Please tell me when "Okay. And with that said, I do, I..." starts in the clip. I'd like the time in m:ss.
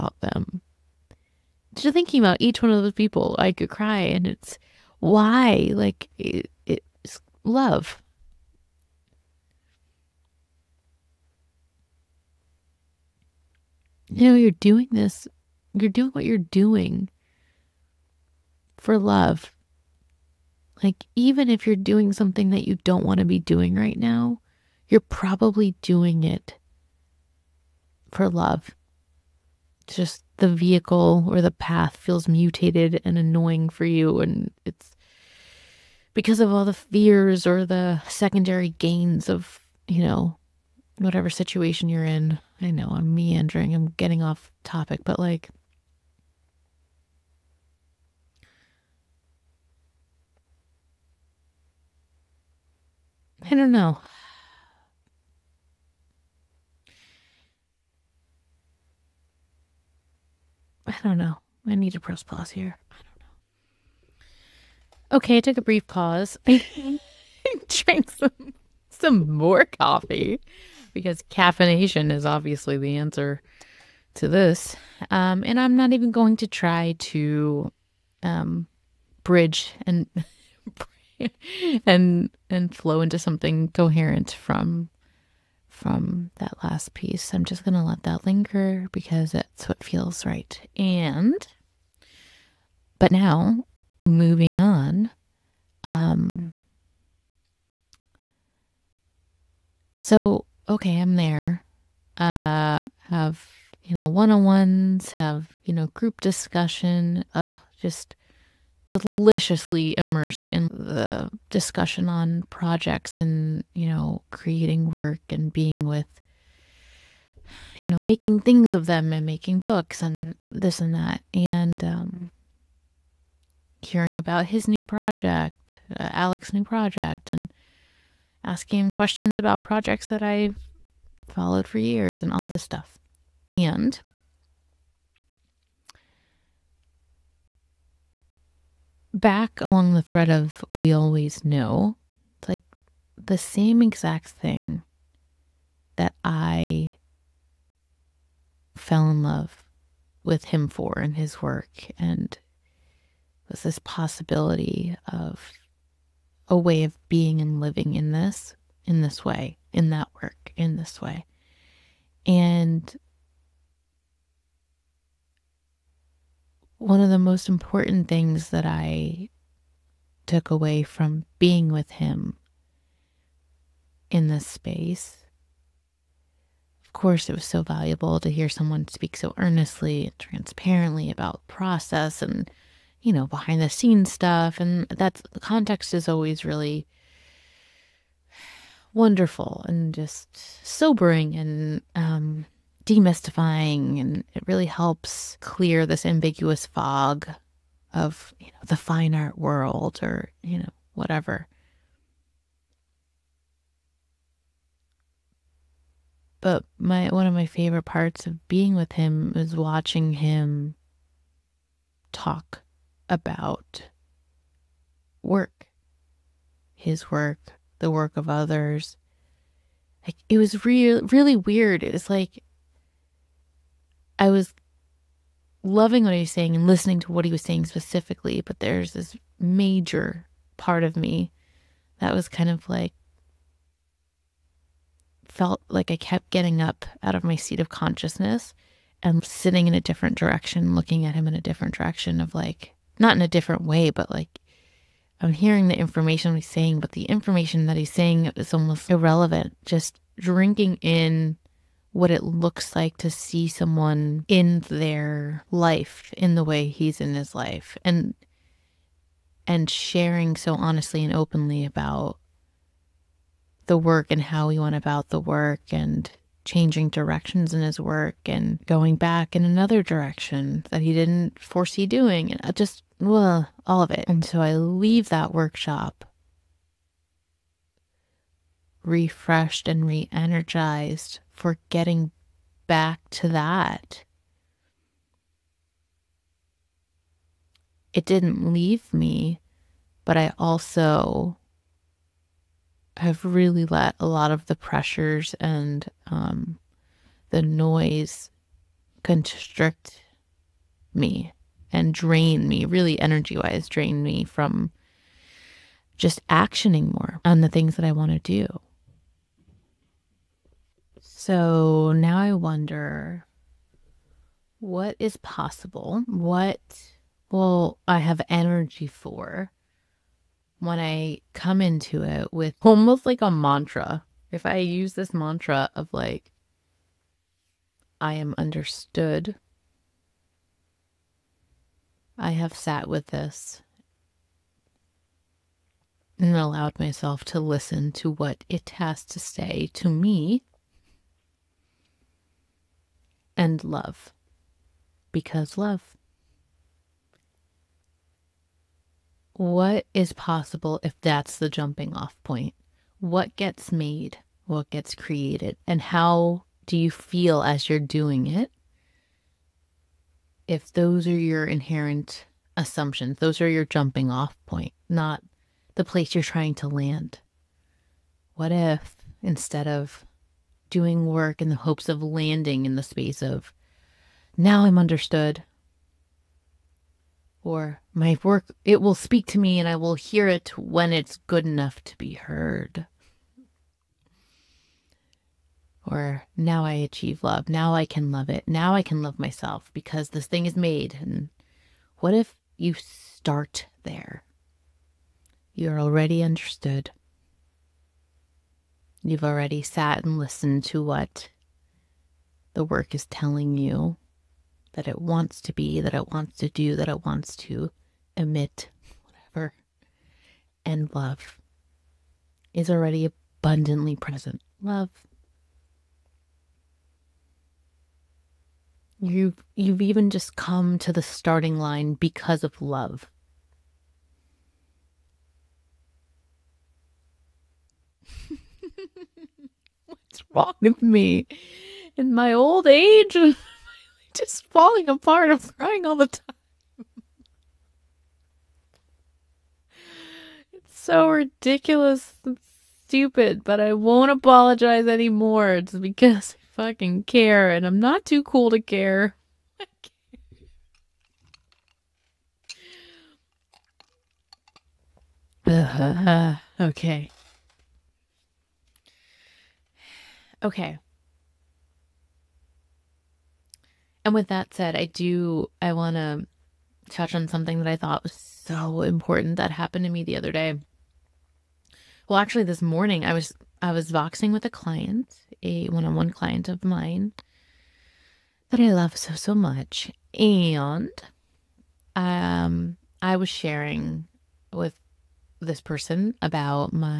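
7:40.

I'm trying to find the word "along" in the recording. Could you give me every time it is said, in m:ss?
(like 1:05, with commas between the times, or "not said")
2:19.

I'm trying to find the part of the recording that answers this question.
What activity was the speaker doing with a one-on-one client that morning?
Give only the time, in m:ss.
7:53.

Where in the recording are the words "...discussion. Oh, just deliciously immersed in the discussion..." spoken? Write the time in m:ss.
1:46.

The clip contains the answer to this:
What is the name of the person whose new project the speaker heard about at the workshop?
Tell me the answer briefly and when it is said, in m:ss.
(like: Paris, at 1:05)
Alec, at 2:06.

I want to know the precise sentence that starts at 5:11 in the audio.
So now I wonder what is possible?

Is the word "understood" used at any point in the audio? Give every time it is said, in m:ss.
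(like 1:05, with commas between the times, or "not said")
5:28, 6:14, 6:36.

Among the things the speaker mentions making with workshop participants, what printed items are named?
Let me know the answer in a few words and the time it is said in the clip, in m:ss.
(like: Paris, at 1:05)
books, at 1:59.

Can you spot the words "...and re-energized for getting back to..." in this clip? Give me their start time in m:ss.
4:39.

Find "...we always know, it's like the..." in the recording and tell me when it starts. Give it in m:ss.
2:20.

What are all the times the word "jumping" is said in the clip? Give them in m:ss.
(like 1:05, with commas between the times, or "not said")
5:51, 6:03.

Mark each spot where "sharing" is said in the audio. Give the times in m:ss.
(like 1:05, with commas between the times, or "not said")
4:19, 8:03.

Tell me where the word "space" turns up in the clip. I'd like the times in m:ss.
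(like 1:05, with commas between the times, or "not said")
2:54, 6:12.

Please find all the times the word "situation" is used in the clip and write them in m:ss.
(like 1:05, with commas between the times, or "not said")
0:41.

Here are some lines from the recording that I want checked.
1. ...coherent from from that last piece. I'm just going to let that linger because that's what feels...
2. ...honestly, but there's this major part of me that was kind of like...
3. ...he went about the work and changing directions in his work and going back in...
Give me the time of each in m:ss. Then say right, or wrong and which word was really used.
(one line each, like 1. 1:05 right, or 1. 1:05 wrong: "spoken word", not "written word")
1. 1:23 right
2. 3:47 wrong: "specifically", not "honestly"
3. 4:24 right.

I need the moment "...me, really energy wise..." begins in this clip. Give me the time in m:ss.
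5:02.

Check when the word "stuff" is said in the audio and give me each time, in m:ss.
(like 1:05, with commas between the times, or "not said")
2:12, 3:04.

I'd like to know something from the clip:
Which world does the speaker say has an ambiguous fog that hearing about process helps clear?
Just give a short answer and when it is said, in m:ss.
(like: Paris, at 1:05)
the fine art world, at 3:18.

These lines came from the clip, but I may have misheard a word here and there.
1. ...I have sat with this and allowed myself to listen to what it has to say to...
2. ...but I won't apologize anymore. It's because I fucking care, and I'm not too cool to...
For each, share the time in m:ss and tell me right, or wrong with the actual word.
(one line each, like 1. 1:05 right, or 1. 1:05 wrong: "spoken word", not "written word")
1. 5:32 right
2. 7:23 right.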